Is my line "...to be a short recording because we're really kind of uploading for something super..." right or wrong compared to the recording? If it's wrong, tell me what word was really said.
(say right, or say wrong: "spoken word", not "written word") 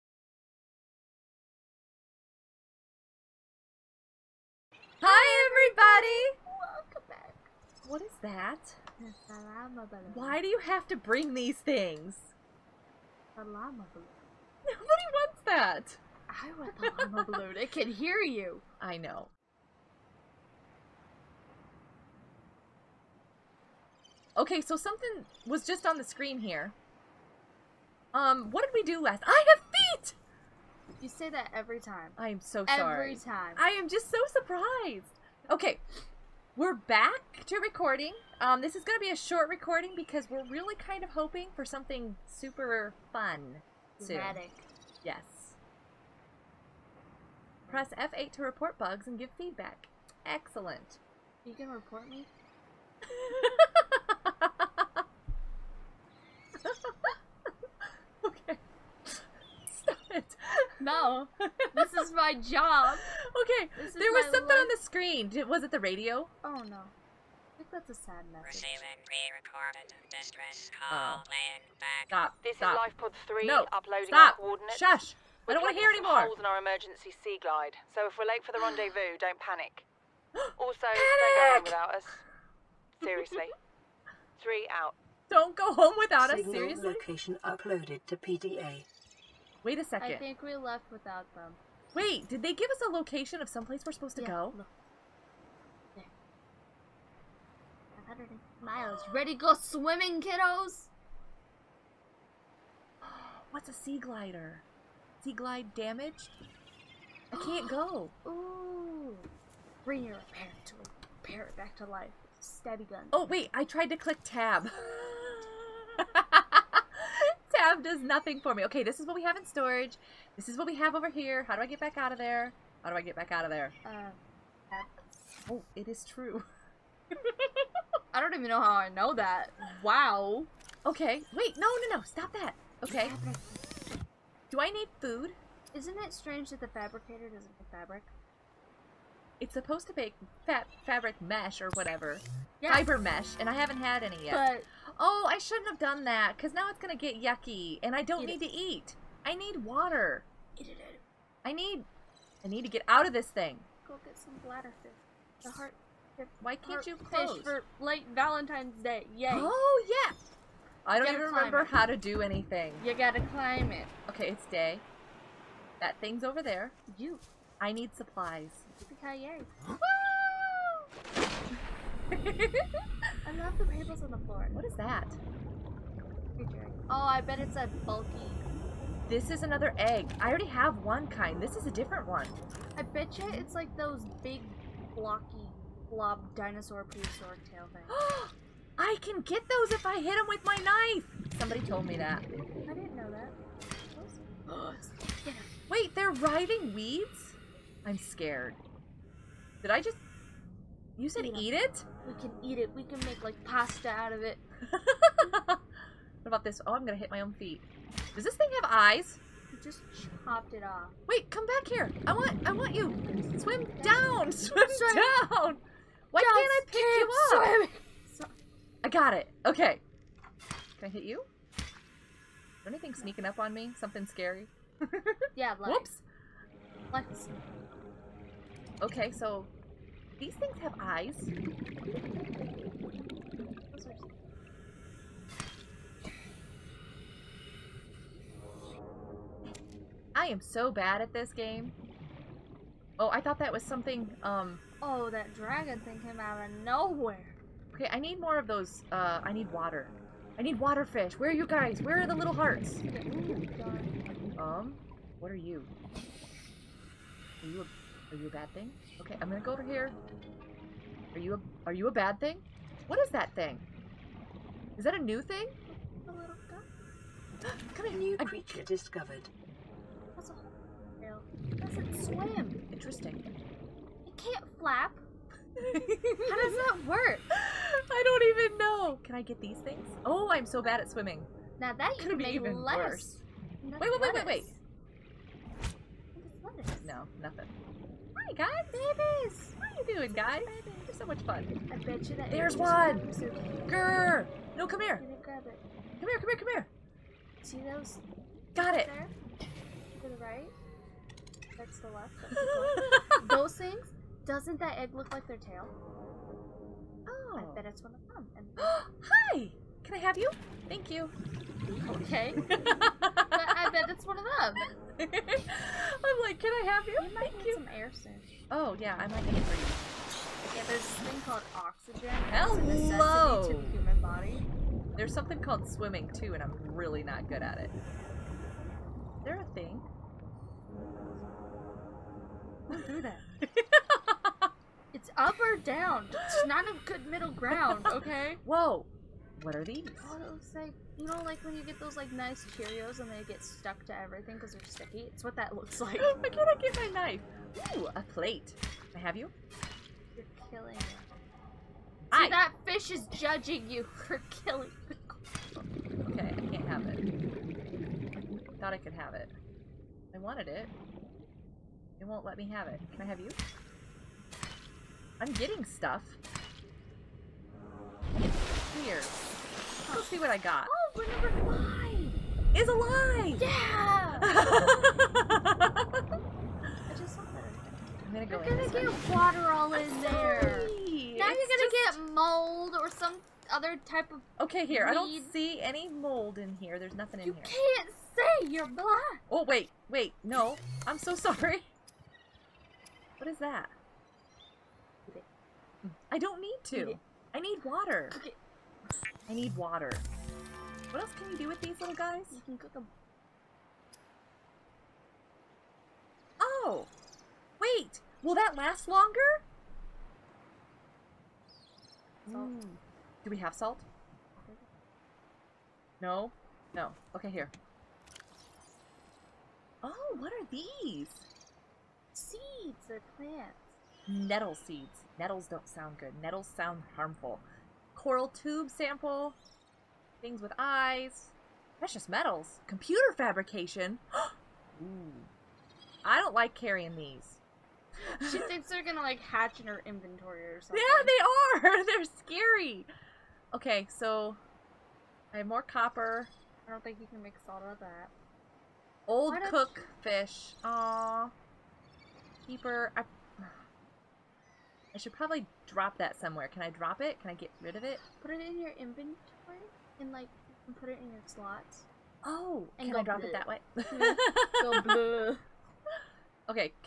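wrong: "hoping", not "uploading".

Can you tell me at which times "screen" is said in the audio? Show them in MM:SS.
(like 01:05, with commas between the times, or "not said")
00:26, 01:04.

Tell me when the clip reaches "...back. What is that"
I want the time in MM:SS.
00:07.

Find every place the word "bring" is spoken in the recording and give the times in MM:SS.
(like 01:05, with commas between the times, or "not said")
00:10, 01:49.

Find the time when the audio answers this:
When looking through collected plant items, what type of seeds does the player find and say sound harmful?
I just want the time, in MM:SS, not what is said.
07:04.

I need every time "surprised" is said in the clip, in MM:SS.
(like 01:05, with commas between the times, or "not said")
00:34.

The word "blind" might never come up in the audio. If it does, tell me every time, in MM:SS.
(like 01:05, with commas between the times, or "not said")
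06:28.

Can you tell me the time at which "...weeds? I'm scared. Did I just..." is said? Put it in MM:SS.
03:16.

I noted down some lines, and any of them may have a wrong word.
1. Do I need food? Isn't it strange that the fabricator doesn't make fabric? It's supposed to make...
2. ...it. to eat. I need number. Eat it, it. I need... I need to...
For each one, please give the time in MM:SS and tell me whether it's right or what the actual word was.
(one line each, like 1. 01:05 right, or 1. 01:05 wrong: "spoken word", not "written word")
1. 02:14 right
2. 02:28 wrong: "water", not "number".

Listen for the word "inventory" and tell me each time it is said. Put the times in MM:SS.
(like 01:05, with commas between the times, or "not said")
07:19, 07:38.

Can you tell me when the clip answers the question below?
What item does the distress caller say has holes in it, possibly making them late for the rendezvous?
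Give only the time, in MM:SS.
01:16.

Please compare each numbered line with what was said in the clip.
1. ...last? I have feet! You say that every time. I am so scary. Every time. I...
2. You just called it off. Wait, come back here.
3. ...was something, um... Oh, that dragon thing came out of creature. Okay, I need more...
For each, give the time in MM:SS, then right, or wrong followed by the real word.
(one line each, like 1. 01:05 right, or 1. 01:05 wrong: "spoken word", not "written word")
1. 00:29 wrong: "sorry", not "scary"
2. 03:29 wrong: "chopped", not "called"
3. 04:03 wrong: "nowhere", not "creature".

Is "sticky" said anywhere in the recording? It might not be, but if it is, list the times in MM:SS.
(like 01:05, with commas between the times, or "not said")
05:44.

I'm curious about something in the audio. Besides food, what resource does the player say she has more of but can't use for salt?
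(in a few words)
Copper.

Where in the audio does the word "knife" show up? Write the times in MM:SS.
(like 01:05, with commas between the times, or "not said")
03:10, 05:46.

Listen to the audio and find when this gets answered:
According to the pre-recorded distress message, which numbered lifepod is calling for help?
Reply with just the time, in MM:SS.
01:12.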